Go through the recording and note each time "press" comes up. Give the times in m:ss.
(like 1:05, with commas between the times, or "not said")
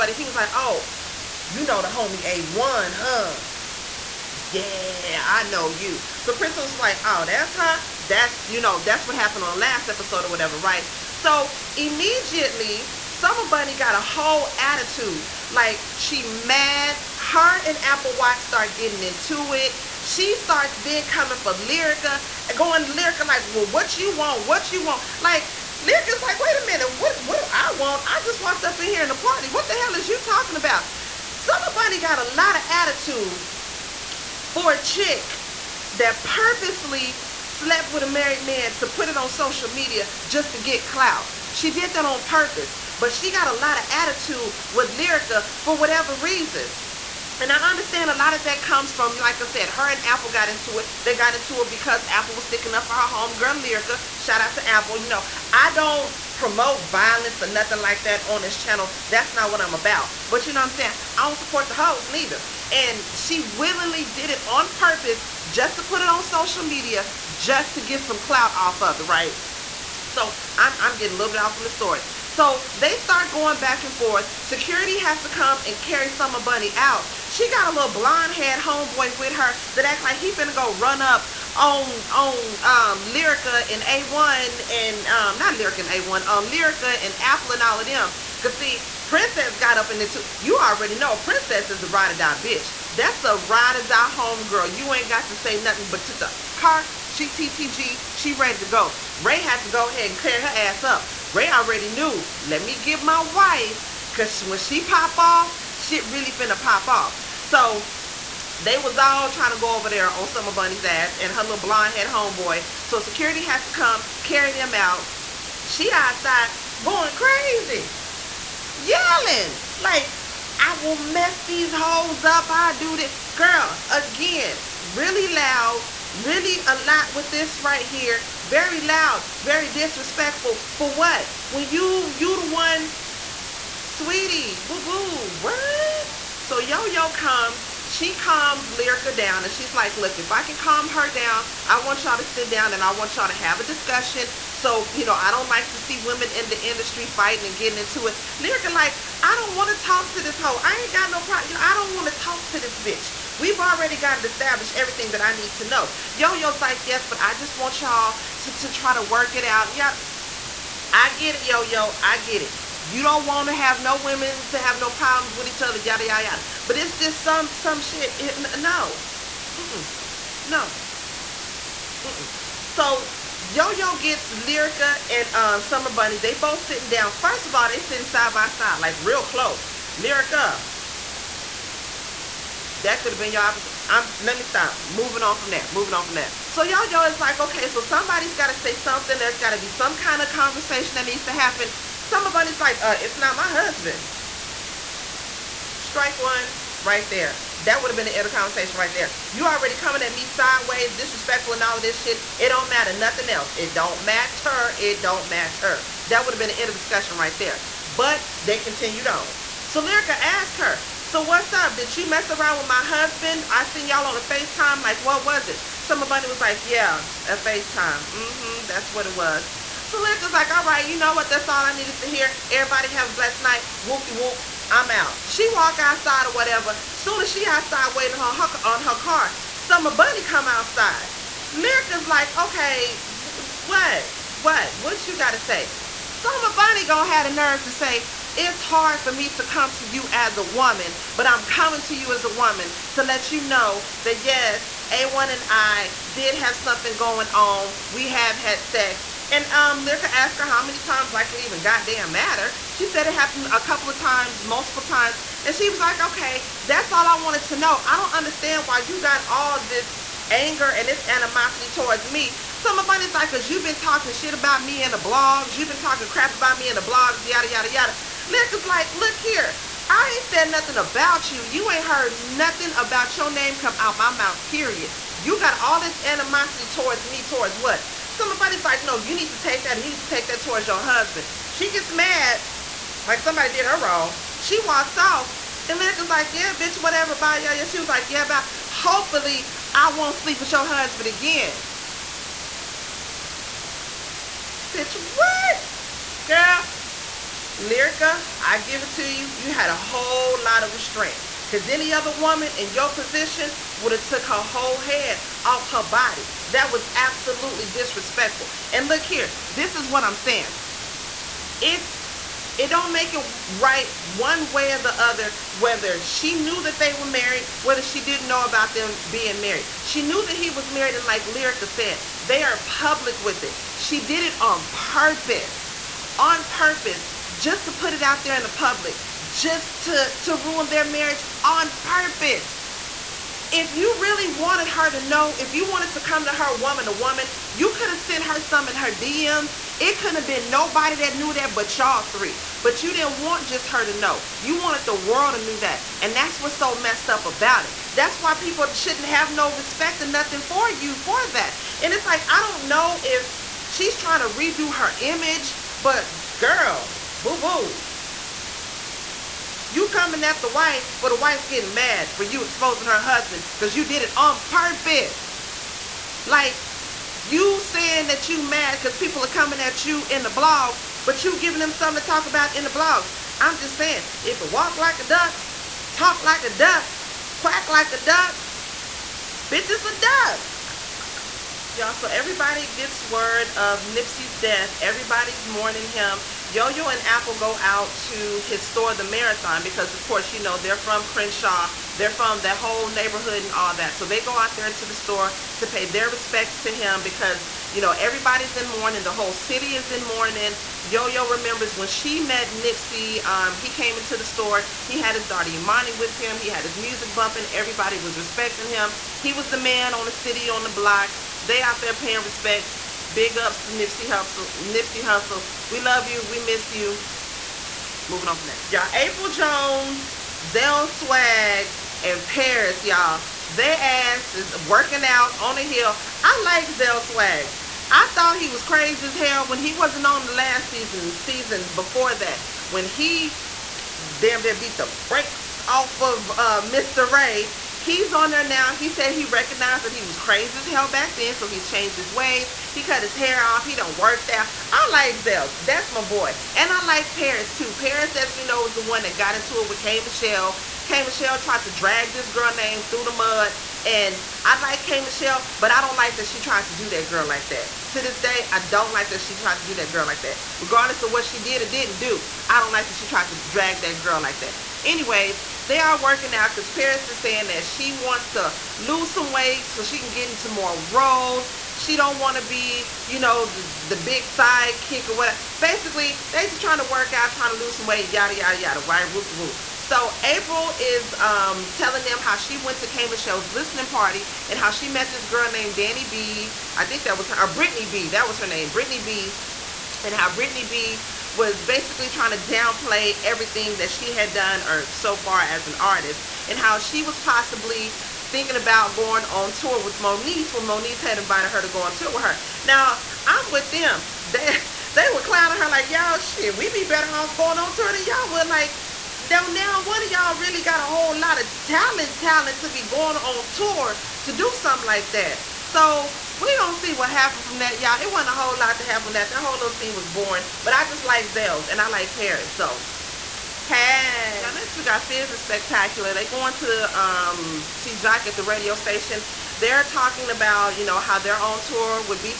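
not said.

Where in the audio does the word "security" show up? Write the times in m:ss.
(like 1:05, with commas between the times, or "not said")
1:14, 1:52.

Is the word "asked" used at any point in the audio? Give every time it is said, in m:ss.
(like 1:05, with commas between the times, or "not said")
3:30, 4:10.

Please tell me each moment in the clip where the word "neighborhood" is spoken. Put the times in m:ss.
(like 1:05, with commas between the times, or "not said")
6:32.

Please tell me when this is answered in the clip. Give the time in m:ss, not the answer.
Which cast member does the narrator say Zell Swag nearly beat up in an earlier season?
7:16.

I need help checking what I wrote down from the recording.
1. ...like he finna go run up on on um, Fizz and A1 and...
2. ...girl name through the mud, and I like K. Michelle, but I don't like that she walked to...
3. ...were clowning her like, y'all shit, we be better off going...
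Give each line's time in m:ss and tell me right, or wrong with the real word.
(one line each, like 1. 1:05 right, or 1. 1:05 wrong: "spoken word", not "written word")
1. 1:20 wrong: "Lyrica", not "Fizz"
2. 7:32 wrong: "tried", not "walked"
3. 8:25 right.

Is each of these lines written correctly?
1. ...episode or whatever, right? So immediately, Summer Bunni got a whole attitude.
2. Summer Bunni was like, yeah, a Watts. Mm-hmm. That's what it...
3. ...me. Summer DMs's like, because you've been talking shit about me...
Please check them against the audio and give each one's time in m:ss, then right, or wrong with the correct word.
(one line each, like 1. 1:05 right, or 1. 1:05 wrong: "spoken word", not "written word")
1. 0:09 right
2. 3:35 wrong: "FaceTime", not "Watts"
3. 4:22 wrong: "Bunni", not "DMs".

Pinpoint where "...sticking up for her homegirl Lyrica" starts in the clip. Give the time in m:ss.
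0:52.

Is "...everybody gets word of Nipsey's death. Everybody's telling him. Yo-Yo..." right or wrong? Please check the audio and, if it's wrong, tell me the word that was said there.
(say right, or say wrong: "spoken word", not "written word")
wrong: "mourning", not "telling".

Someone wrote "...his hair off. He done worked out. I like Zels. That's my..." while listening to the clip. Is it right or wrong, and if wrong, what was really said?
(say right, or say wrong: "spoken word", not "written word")
right.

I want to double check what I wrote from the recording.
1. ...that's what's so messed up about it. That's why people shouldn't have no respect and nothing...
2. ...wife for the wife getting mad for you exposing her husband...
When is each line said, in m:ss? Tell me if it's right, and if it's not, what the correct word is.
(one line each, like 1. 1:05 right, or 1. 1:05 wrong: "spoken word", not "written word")
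1. 5:46 right
2. 6:00 right.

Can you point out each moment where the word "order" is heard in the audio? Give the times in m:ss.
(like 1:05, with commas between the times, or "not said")
not said.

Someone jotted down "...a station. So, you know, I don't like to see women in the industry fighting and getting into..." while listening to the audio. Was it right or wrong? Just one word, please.
wrong.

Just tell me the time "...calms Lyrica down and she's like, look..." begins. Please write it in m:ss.
2:18.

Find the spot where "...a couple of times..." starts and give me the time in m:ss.
4:13.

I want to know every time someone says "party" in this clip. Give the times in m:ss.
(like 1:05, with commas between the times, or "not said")
0:29, 8:03.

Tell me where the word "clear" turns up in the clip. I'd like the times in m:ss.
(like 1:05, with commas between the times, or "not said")
1:40.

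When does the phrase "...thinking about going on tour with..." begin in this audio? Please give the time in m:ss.
8:18.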